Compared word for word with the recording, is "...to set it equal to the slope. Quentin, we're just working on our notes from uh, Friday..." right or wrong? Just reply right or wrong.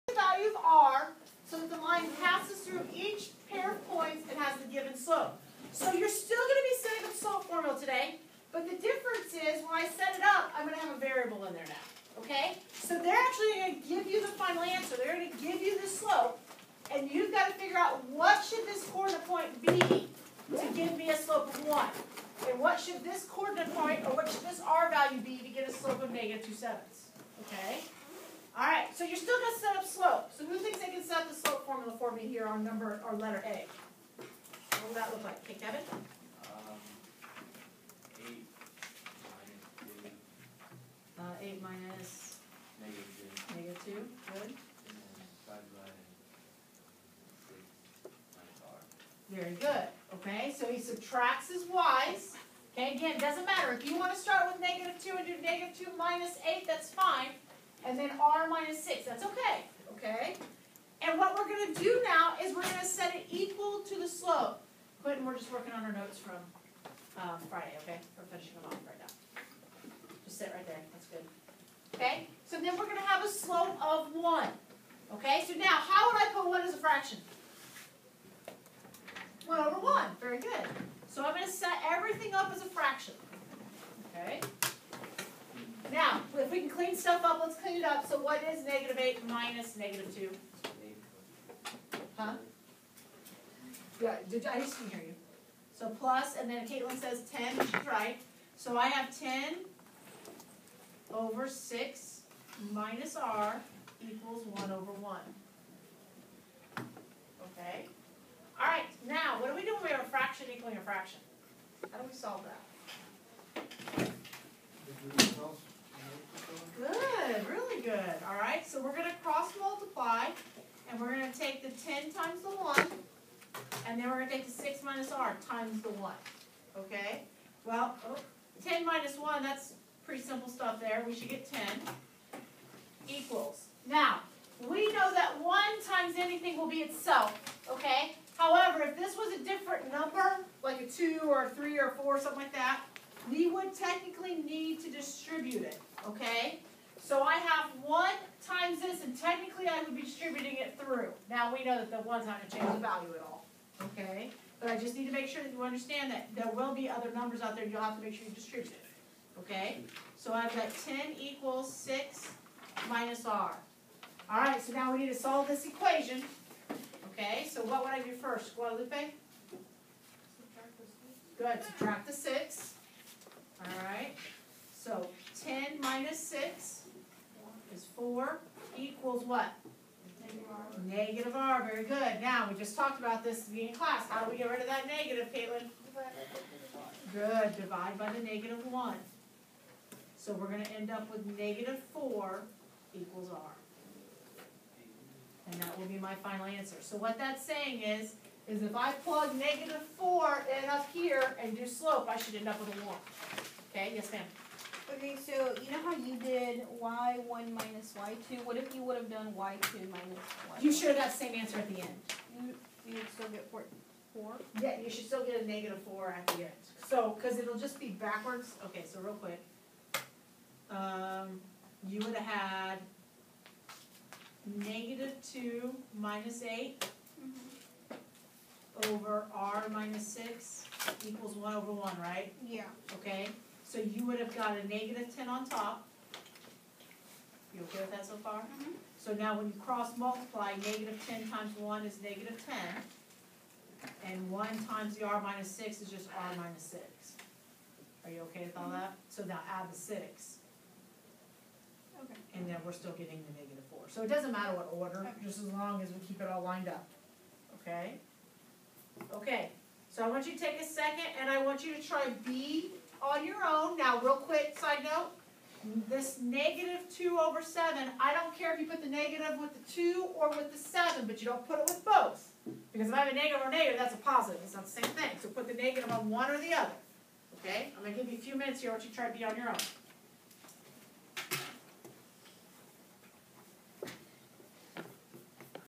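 right.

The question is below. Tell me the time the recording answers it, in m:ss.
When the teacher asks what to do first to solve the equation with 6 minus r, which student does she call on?
2:48.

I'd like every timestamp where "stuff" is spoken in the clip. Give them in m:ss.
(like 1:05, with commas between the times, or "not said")
1:26, 2:10.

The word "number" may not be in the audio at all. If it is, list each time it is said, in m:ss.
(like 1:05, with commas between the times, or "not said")
0:32, 2:19, 2:37.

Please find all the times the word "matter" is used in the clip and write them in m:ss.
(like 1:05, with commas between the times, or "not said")
0:53, 4:14.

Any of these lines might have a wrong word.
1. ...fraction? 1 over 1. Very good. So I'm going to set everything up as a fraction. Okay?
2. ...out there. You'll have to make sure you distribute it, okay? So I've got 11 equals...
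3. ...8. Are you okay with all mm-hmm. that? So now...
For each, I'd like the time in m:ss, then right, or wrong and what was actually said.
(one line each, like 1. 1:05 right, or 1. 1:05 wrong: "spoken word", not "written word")
1. 1:16 right
2. 2:37 wrong: "10", not "11"
3. 4:06 wrong: "6", not "8".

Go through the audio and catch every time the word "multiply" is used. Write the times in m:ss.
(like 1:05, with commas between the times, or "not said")
1:59, 3:59.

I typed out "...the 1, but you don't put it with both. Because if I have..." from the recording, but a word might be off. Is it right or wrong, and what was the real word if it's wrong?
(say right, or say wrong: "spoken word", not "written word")
wrong: "7", not "1".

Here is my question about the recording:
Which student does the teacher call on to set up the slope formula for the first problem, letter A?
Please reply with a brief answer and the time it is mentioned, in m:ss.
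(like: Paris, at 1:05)
Kevin, at 0:35.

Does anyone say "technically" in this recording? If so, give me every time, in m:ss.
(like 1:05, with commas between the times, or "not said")
2:23, 2:29.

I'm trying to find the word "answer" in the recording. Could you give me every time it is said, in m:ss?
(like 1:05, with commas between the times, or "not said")
0:14, 3:16, 3:31.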